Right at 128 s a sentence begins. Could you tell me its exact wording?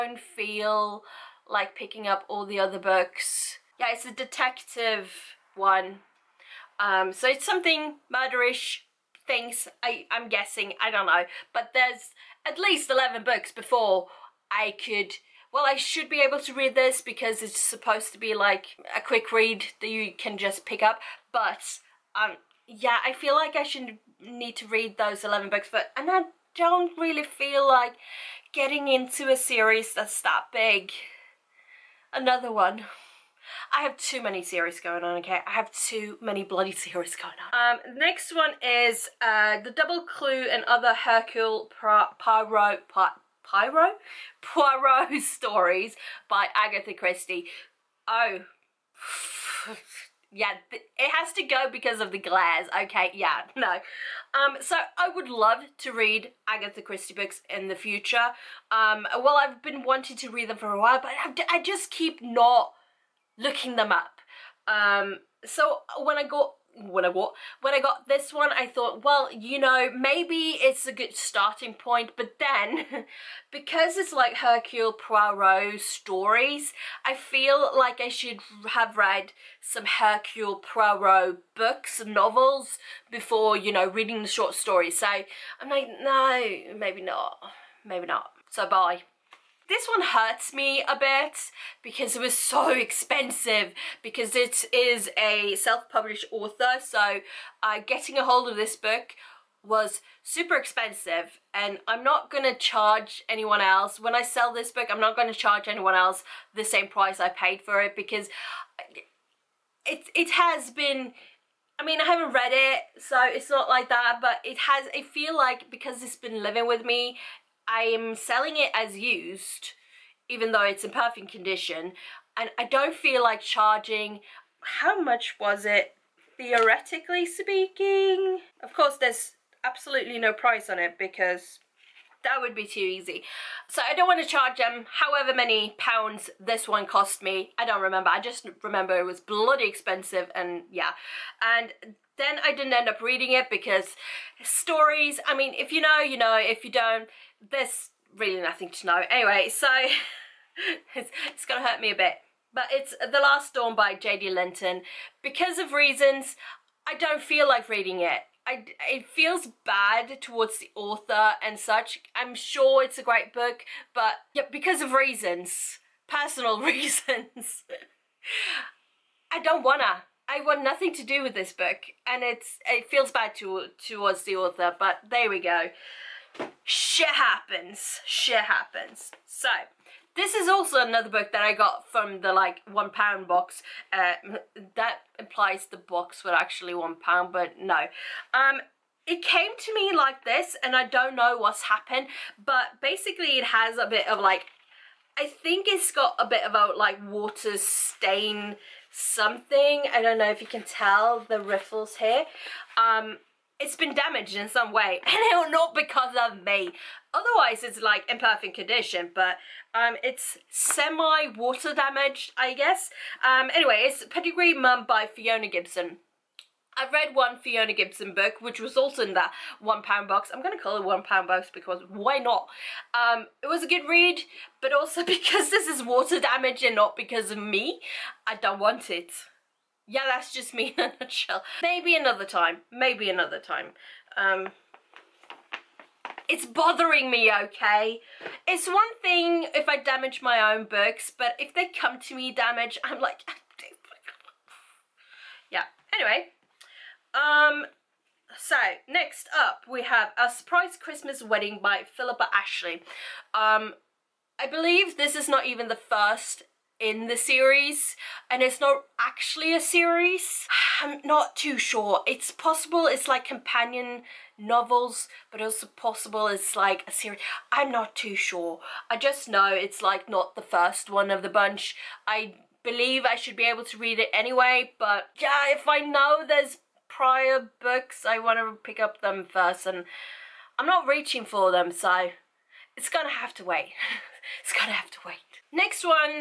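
Of course, there's absolutely no price on it because that would be too easy.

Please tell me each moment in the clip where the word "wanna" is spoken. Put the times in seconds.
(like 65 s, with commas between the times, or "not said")
169 s.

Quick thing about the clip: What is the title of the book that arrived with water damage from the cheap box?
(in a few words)
Pedigree Mum.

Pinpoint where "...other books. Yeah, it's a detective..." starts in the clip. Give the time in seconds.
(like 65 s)
2 s.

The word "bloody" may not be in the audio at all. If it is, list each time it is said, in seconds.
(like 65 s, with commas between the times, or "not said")
36 s, 139 s.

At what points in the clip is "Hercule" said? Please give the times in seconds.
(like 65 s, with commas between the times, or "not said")
40 s, 74 s, 79 s.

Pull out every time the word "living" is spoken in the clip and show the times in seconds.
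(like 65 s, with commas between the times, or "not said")
116 s.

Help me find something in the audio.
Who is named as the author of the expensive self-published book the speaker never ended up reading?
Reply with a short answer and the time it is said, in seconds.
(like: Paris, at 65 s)
J.D. Linton, at 153 s.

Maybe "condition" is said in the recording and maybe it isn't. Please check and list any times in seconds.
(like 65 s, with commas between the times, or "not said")
121 s, 208 s.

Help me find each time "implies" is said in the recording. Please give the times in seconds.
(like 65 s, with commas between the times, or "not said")
185 s.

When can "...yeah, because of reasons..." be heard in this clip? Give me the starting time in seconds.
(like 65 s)
164 s.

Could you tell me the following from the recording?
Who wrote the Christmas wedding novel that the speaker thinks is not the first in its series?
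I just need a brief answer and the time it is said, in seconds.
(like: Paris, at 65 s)
Philippa Ashley, at 251 s.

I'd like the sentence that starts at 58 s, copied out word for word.
Um, well, I've been wanting to read them for a while, but I just keep not looking them up.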